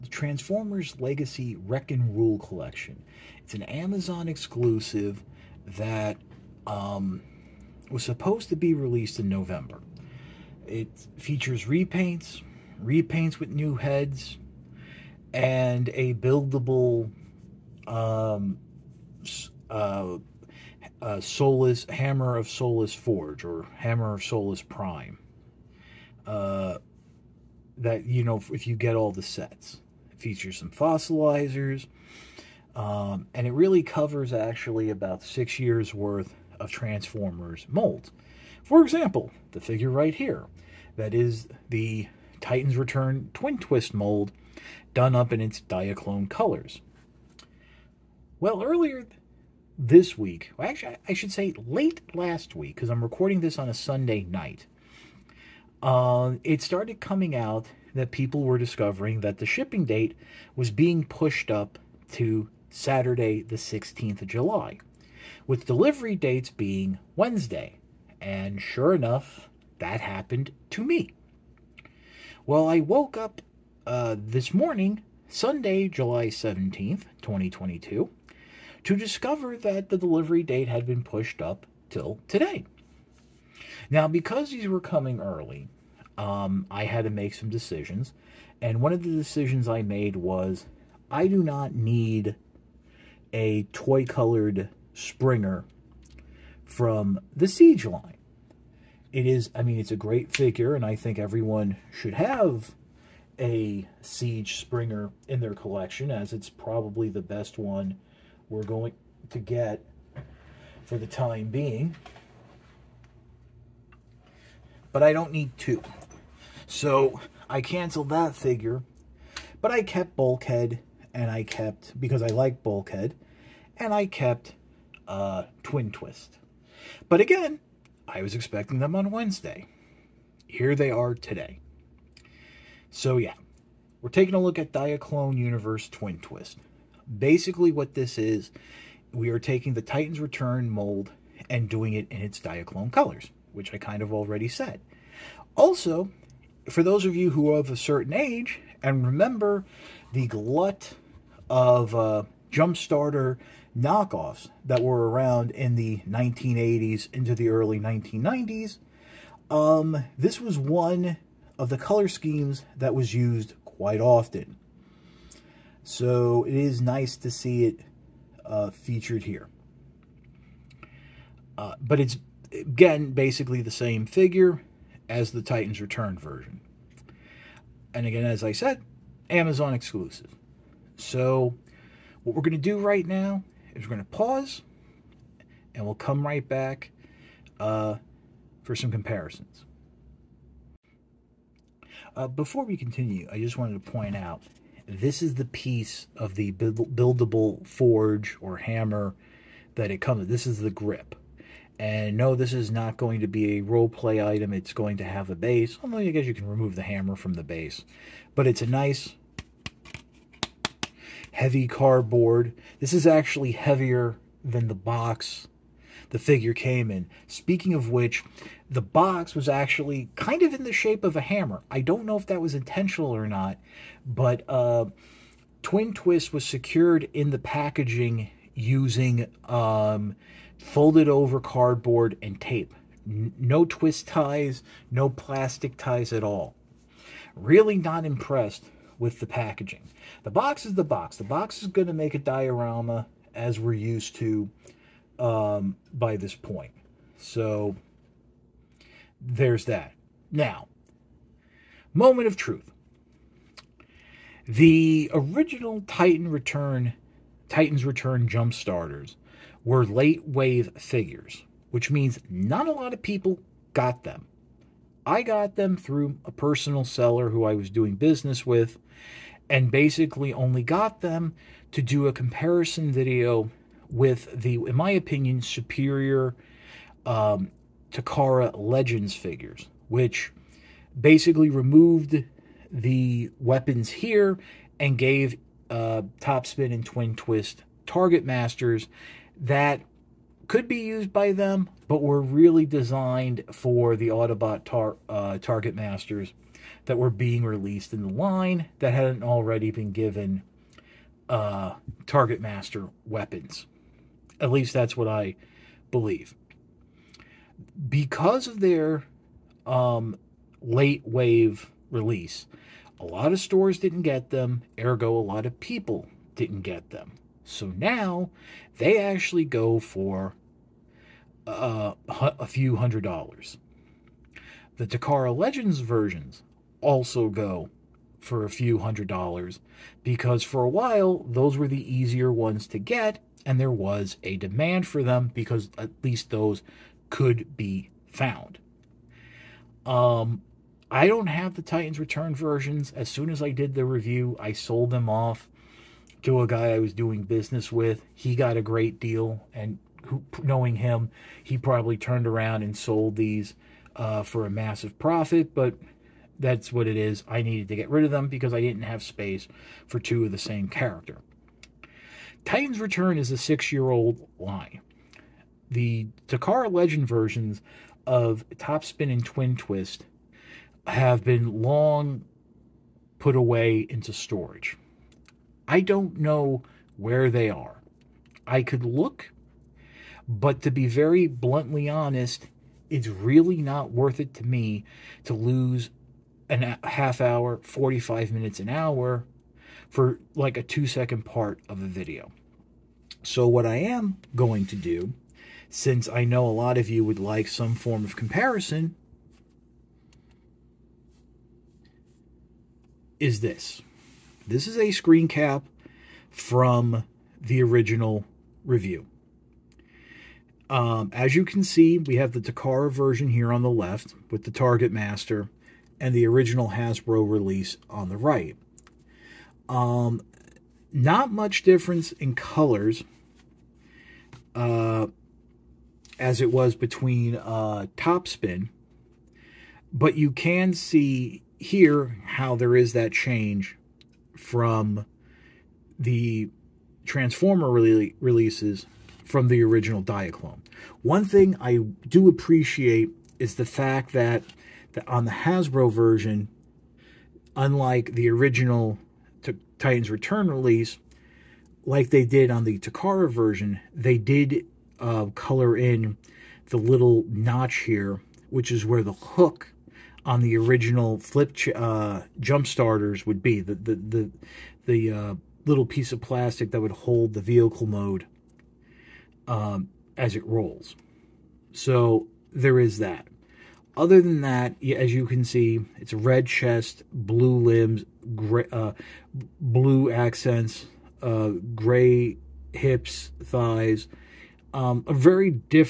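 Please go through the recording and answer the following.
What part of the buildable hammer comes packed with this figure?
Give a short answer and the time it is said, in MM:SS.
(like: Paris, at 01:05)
The grip, at 03:20.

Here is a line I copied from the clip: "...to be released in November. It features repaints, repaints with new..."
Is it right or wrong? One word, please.
right.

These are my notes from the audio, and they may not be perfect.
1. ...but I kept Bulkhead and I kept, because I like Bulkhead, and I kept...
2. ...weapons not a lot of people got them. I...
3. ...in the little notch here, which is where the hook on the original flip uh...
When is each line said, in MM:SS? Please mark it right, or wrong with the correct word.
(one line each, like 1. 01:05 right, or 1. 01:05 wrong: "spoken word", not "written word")
1. 01:59 right
2. 04:21 wrong: "means", not "weapons"
3. 07:35 right.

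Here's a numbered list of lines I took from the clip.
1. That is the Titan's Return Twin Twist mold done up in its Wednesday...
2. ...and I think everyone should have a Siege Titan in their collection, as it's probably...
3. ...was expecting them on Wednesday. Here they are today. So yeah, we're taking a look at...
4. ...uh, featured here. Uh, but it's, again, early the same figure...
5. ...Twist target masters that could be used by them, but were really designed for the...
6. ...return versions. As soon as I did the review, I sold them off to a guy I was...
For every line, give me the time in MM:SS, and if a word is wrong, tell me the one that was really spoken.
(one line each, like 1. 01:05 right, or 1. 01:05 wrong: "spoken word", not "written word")
1. 00:40 wrong: "Diaclone", not "Wednesday"
2. 01:40 wrong: "Springer", not "Titan"
3. 02:08 right
4. 02:48 wrong: "basically", not "early"
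5. 04:47 right
6. 05:41 right.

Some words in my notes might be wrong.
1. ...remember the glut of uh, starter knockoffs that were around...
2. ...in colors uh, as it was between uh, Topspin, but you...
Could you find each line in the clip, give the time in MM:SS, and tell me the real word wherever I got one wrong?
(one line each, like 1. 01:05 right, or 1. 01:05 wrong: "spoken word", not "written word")
1. 02:29 right
2. 07:02 right.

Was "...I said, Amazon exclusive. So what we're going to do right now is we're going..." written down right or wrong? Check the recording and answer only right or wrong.
right.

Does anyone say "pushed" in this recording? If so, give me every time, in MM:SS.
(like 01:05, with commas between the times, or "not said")
01:01, 01:21.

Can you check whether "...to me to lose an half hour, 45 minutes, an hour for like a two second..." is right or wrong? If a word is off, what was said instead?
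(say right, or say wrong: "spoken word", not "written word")
right.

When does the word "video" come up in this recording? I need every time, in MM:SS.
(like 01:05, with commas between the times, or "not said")
04:32, 06:31.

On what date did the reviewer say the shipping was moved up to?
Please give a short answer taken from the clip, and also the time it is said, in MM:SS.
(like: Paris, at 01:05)
Saturday, July 16, at 01:02.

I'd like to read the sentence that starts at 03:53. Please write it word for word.
N no twist ties, no plastic ties at all.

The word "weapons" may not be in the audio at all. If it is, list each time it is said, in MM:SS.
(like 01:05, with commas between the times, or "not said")
04:43, 05:03.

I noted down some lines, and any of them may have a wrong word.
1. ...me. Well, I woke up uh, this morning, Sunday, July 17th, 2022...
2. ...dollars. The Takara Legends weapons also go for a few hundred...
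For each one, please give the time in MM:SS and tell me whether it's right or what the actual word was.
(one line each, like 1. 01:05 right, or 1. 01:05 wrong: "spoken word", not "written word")
1. 01:10 right
2. 05:23 wrong: "versions", not "weapons".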